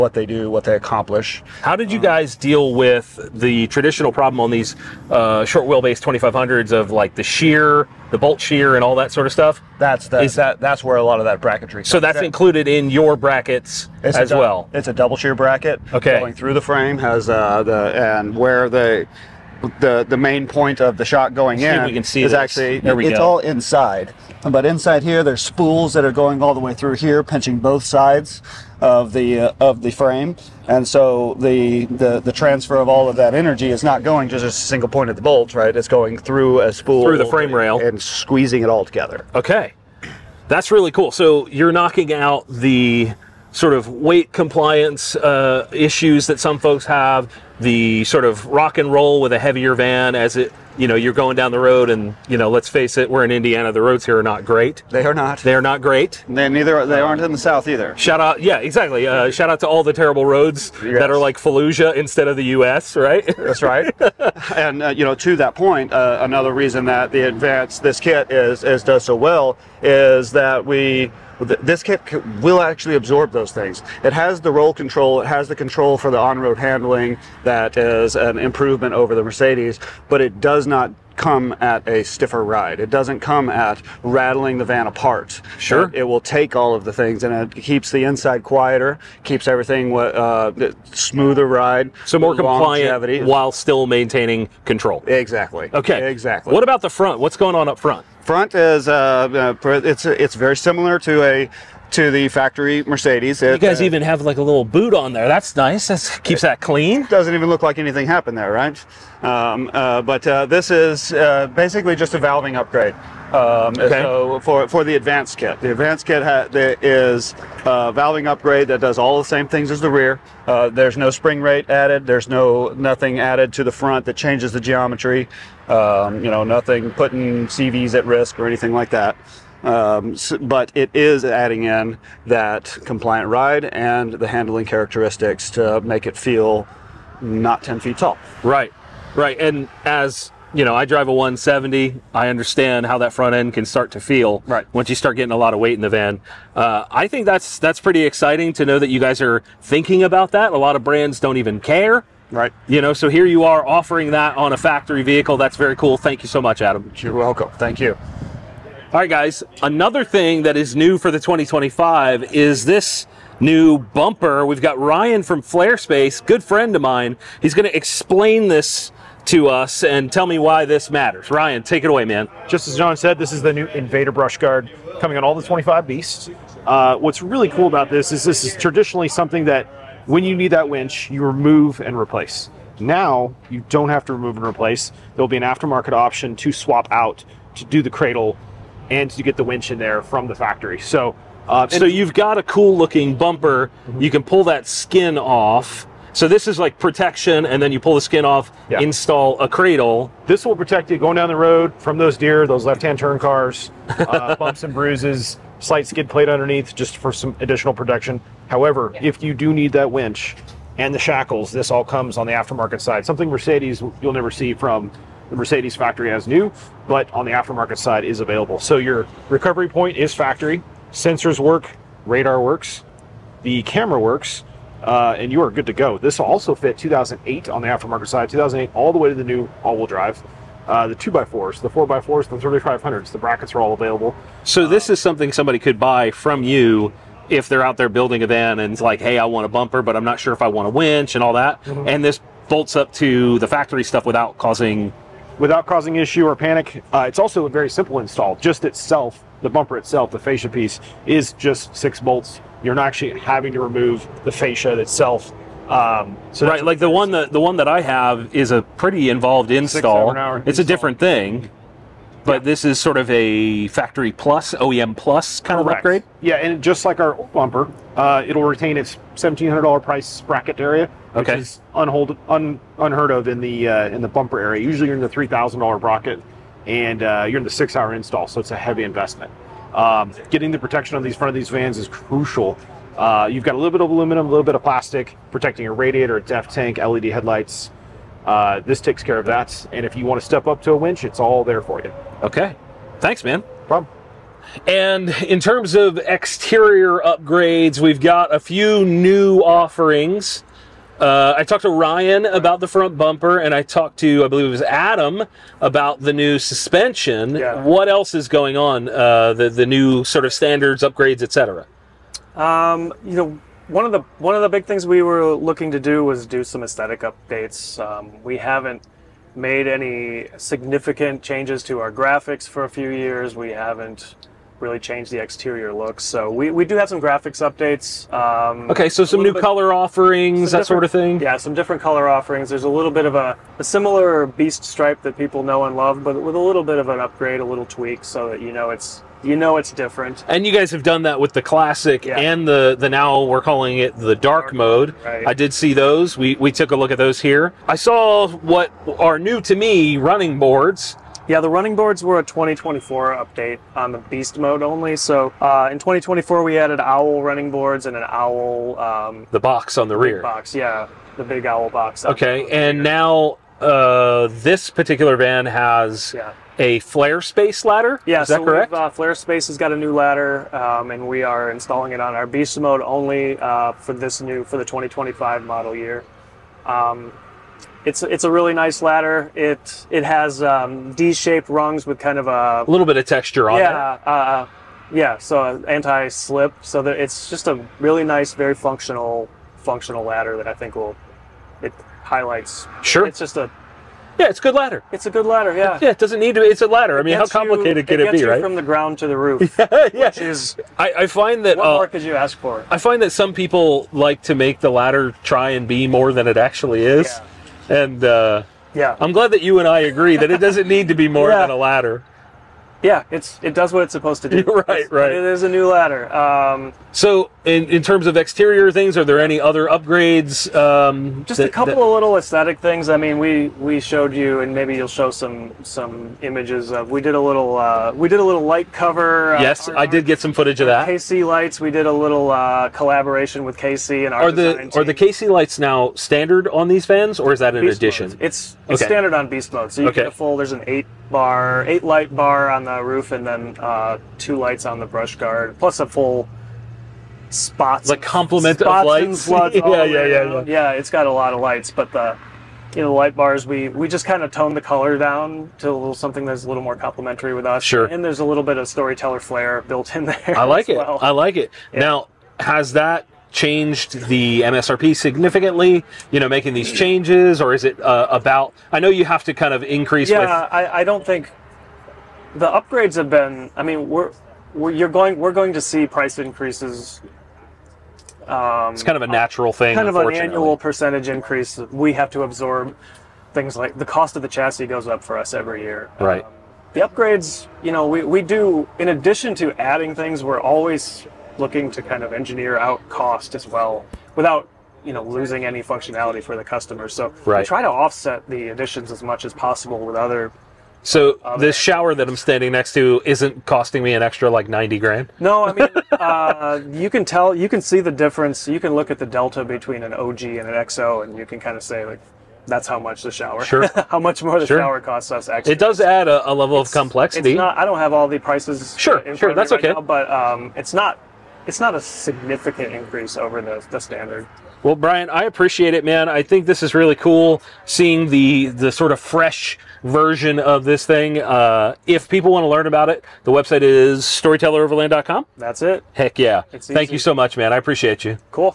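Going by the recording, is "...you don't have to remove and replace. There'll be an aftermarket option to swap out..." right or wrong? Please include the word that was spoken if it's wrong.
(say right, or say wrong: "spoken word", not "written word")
right.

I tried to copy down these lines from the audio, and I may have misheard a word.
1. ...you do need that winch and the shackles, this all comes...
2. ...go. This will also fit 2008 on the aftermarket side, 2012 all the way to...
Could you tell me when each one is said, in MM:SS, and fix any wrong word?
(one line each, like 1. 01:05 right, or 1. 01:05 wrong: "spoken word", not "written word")
1. 03:29 right
2. 03:45 wrong: "2008", not "2012".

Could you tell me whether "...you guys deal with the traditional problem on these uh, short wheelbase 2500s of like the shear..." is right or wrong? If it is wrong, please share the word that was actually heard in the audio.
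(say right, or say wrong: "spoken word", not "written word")
right.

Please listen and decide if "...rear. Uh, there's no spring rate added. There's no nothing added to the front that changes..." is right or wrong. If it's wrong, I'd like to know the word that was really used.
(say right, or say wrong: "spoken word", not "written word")
right.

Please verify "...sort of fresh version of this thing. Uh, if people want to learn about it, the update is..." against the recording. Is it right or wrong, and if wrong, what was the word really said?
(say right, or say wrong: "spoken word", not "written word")
wrong: "website", not "update".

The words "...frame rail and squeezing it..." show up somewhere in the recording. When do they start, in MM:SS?
00:37.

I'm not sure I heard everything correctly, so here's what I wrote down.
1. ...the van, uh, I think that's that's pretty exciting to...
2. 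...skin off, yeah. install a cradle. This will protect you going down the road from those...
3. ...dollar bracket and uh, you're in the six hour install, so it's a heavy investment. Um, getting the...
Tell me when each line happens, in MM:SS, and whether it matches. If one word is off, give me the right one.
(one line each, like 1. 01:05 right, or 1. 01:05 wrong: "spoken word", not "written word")
1. 02:25 right
2. 03:17 right
3. 04:35 right.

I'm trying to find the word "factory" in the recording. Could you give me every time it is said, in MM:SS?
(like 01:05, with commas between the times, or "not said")
01:42, 02:34, 03:10, 03:35, 03:40, 04:03, 04:23.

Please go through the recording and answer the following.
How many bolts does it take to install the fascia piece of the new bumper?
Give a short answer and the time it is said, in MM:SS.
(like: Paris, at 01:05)
6, at 04:11.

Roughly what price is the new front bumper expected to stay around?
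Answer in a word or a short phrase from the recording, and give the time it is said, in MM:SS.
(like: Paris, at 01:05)
$1,700, at 04:29.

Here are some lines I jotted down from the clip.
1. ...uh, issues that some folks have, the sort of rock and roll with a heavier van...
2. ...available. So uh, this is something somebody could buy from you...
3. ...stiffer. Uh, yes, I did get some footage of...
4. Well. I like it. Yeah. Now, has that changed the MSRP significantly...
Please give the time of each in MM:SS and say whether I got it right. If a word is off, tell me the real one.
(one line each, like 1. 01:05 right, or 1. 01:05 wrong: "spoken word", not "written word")
1. 00:45 right
2. 03:53 right
3. 07:08 wrong: "cover", not "stiffer"
4. 07:40 right.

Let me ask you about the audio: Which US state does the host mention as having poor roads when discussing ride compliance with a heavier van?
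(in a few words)
Indiana.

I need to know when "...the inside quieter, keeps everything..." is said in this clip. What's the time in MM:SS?
01:27.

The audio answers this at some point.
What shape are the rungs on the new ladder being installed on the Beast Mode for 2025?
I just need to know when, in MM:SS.
06:20.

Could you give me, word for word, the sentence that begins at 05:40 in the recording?
And you guys have done that with the classic yeah.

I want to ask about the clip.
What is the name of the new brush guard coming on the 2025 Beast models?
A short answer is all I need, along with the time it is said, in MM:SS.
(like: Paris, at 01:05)
Invader, at 02:53.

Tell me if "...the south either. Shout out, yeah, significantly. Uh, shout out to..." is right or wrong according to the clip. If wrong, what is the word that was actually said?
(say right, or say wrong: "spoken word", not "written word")
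wrong: "exactly", not "significantly".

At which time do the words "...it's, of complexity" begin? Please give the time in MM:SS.
08:36.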